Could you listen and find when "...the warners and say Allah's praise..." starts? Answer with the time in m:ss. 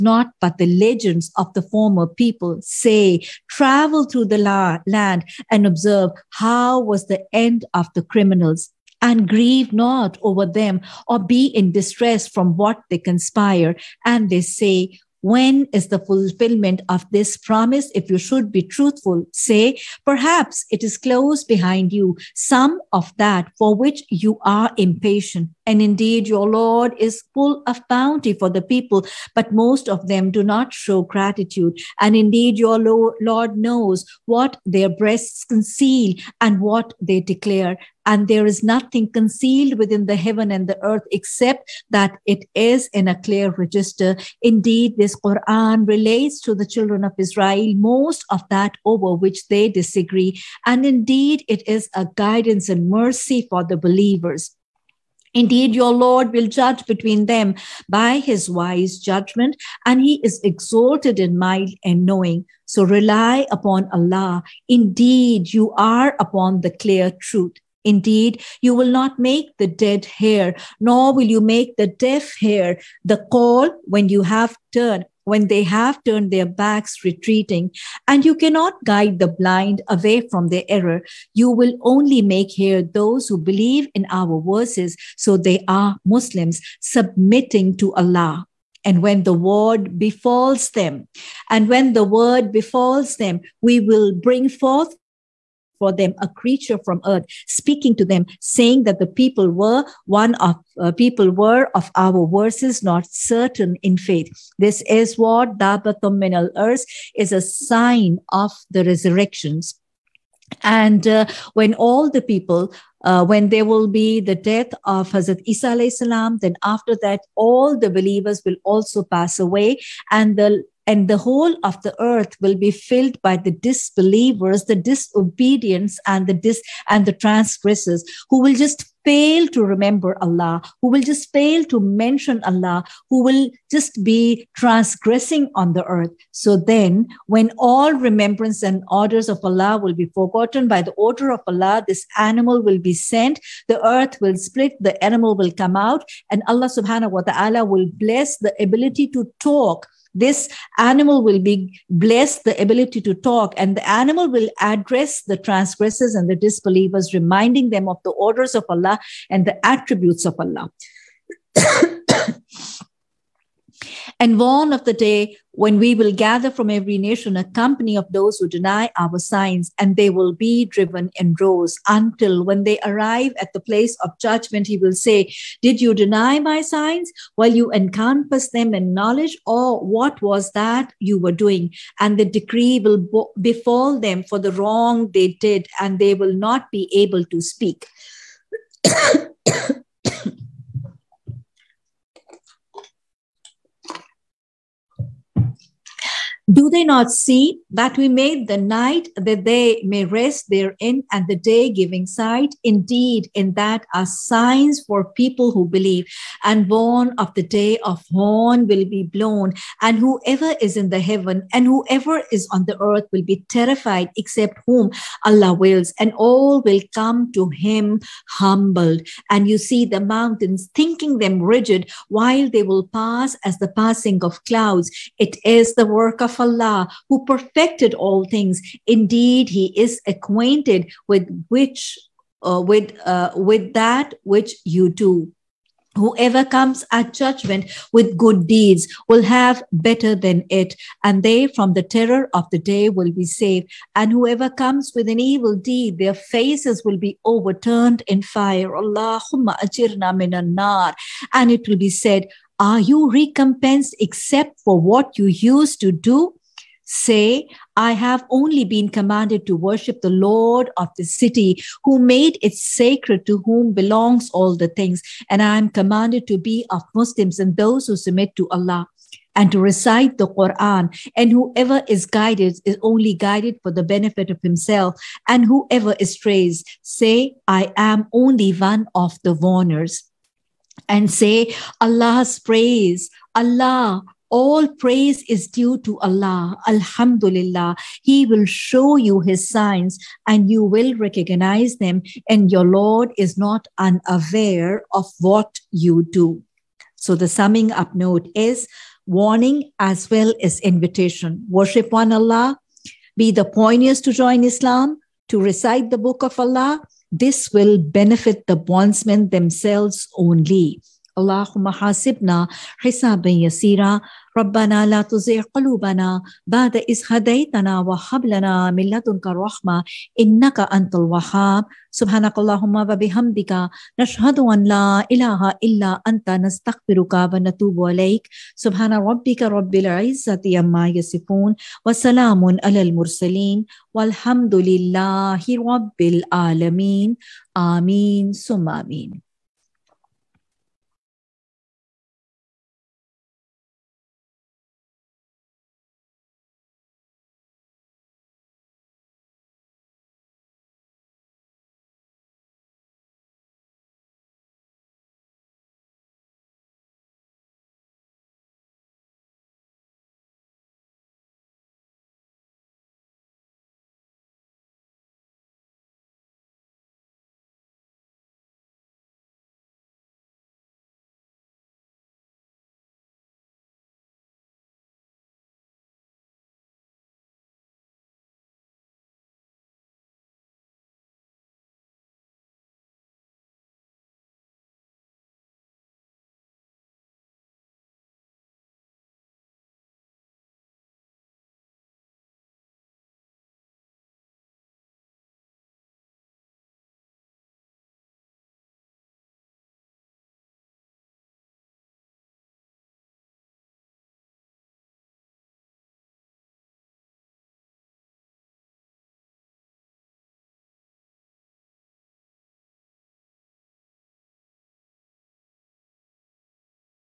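4:39.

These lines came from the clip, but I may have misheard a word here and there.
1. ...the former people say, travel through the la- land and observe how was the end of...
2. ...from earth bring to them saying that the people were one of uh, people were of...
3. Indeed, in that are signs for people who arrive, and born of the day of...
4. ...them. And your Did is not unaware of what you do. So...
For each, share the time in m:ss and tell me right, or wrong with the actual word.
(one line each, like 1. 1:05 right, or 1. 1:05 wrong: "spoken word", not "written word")
1. 0:01 right
2. 1:36 wrong: "speaking", not "bring"
3. 3:22 wrong: "believe", not "arrive"
4. 4:51 wrong: "Lord", not "Did".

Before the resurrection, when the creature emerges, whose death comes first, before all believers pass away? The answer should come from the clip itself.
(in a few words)
Hazrat Isa.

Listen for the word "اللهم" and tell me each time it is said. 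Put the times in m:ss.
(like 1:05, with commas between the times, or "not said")
5:11, 5:22.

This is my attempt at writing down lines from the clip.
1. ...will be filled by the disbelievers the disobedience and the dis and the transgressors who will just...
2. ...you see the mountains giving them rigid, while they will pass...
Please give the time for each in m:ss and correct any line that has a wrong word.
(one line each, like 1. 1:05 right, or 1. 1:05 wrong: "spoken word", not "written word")
1. 2:02 right
2. 3:39 wrong: "thinking", not "giving".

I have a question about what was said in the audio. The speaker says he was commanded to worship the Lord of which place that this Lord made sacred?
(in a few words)
The city.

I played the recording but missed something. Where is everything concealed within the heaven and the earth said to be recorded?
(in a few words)
A clear register.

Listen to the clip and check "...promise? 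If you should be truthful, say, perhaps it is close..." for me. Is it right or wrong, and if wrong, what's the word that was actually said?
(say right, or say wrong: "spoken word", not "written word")
right.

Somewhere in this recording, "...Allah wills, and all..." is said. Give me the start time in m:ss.
3:35.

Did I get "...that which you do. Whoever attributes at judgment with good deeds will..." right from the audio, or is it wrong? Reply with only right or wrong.
wrong.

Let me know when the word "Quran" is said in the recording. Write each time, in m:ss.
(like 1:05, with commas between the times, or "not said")
0:45, 4:30.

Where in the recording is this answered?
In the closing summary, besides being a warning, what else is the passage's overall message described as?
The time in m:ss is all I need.
5:00.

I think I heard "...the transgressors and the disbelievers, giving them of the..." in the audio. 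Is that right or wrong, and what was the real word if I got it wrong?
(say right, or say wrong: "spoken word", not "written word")
wrong: "reminding", not "giving".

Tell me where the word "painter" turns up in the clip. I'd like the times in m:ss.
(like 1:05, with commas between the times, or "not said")
not said.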